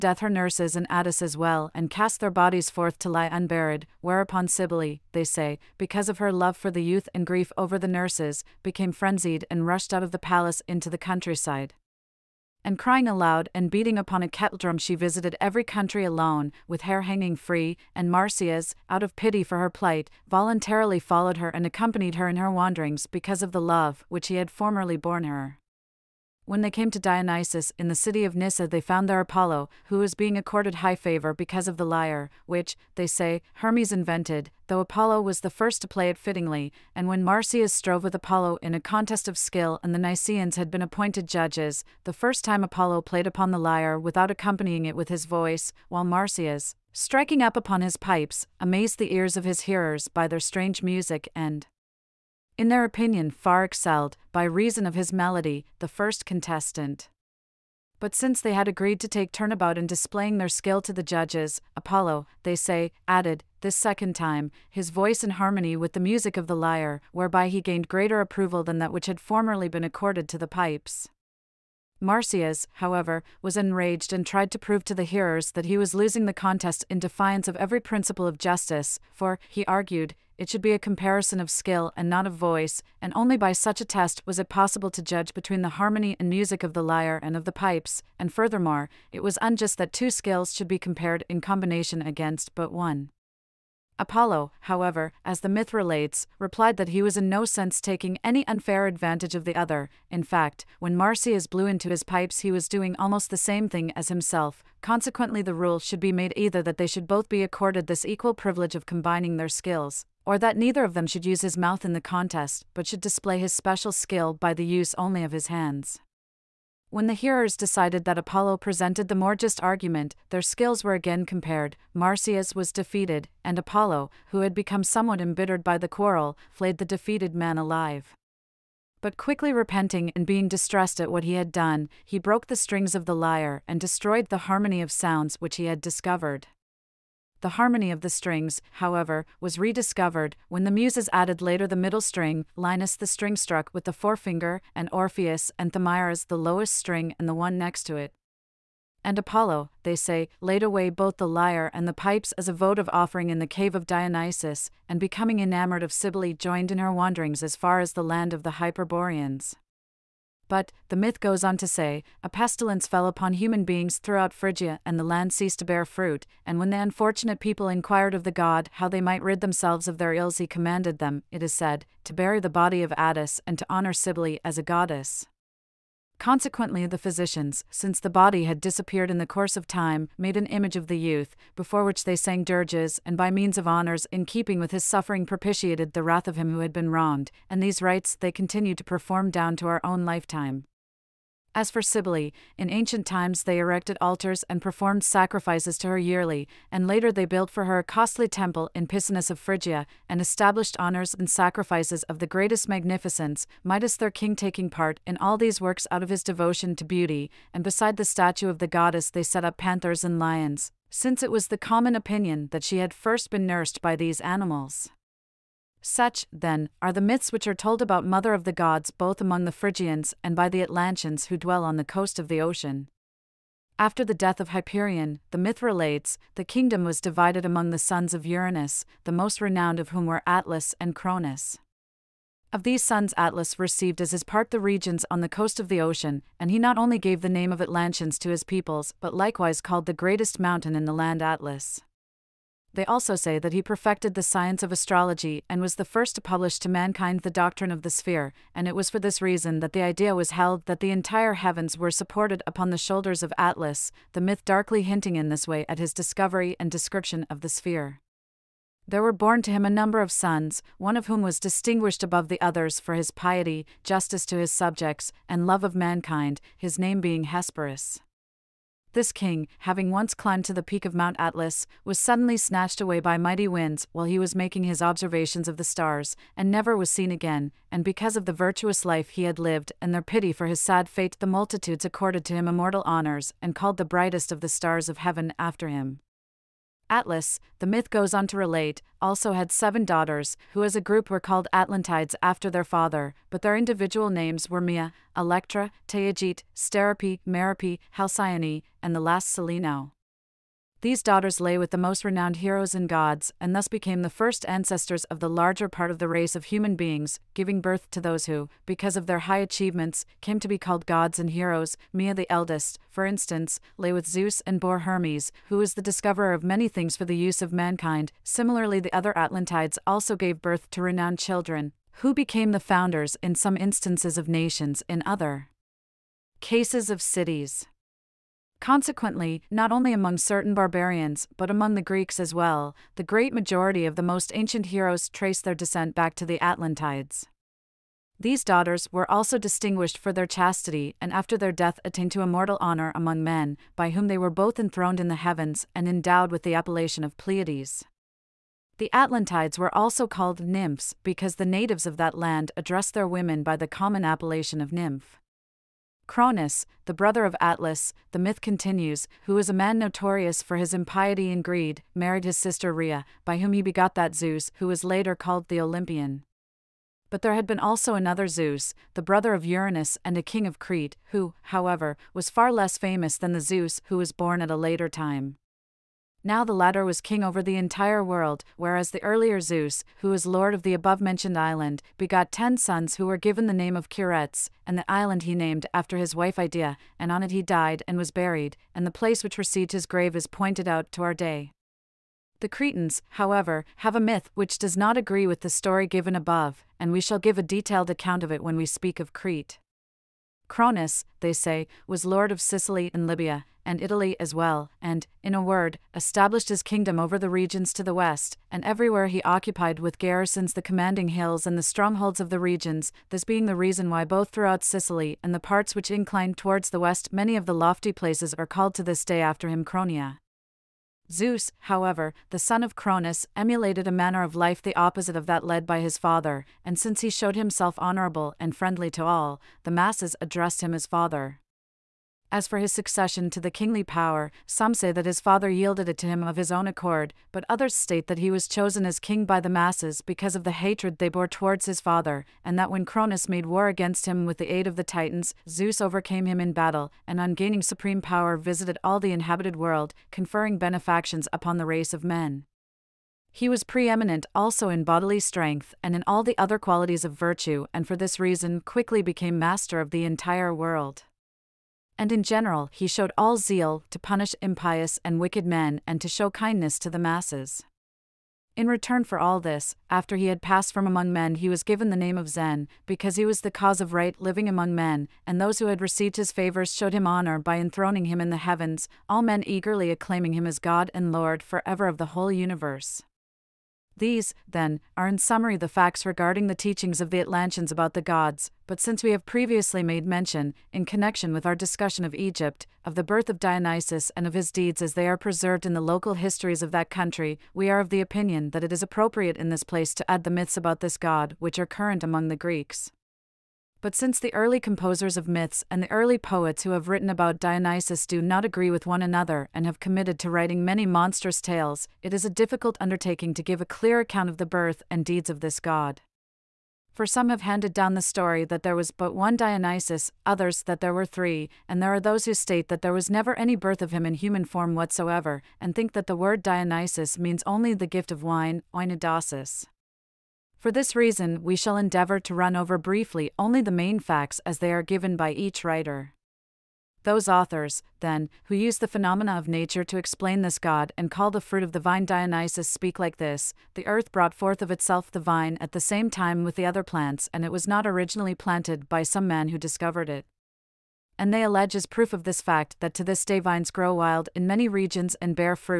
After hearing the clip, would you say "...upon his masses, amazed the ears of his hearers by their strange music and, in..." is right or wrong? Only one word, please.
wrong.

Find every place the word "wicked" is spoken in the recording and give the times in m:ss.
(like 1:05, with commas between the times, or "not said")
7:45.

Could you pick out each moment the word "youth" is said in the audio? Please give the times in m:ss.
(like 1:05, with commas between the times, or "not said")
0:06, 3:00.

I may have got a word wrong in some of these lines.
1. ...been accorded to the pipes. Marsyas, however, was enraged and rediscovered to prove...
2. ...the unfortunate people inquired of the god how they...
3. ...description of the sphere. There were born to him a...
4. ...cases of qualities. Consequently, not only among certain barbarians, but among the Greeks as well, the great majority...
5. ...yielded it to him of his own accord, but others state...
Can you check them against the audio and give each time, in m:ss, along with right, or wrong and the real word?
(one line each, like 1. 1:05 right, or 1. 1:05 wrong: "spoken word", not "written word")
1. 1:09 wrong: "tried", not "rediscovered"
2. 2:46 right
3. 4:16 right
4. 5:26 wrong: "cities", not "qualities"
5. 7:15 right.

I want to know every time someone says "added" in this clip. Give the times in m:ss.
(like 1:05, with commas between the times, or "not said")
1:03, 2:21.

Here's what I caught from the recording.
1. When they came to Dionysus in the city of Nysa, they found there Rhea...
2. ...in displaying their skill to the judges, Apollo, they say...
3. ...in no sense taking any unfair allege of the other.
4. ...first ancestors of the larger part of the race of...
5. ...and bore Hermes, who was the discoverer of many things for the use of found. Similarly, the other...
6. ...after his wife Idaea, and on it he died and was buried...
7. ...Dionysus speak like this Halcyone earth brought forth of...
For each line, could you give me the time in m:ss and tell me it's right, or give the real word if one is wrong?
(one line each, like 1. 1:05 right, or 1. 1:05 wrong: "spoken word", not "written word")
1. 0:26 wrong: "Apollo", not "Rhea"
2. 0:59 right
3. 1:37 wrong: "advantage", not "allege"
4. 5:04 right
5. 5:14 wrong: "mankind", not "found"
6. 6:25 right
7. 9:02 wrong: "The", not "Halcyone".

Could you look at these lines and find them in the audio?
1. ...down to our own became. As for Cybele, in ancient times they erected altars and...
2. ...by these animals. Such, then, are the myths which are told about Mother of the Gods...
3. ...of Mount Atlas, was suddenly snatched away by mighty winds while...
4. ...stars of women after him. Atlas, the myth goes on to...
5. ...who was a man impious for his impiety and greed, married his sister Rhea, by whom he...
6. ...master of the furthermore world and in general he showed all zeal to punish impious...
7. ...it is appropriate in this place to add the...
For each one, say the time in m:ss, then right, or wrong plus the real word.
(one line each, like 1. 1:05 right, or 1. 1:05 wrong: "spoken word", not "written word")
1. 3:09 wrong: "lifetime", not "became"
2. 3:33 right
3. 4:30 right
4. 4:44 wrong: "heaven", not "women"
5. 5:59 wrong: "notorious", not "impious"
6. 7:39 wrong: "entire", not "furthermore"
7. 8:18 right.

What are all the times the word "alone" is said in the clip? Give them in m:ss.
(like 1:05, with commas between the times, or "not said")
0:16.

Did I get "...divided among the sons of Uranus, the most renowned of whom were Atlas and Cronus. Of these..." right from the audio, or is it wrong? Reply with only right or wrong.
right.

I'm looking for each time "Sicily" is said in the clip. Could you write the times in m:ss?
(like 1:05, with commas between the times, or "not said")
6:42, 6:54.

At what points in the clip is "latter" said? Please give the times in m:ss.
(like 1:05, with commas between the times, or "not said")
6:16.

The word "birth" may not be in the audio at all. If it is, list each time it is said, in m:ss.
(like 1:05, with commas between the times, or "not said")
5:07, 5:20, 8:13, 8:34, 8:43.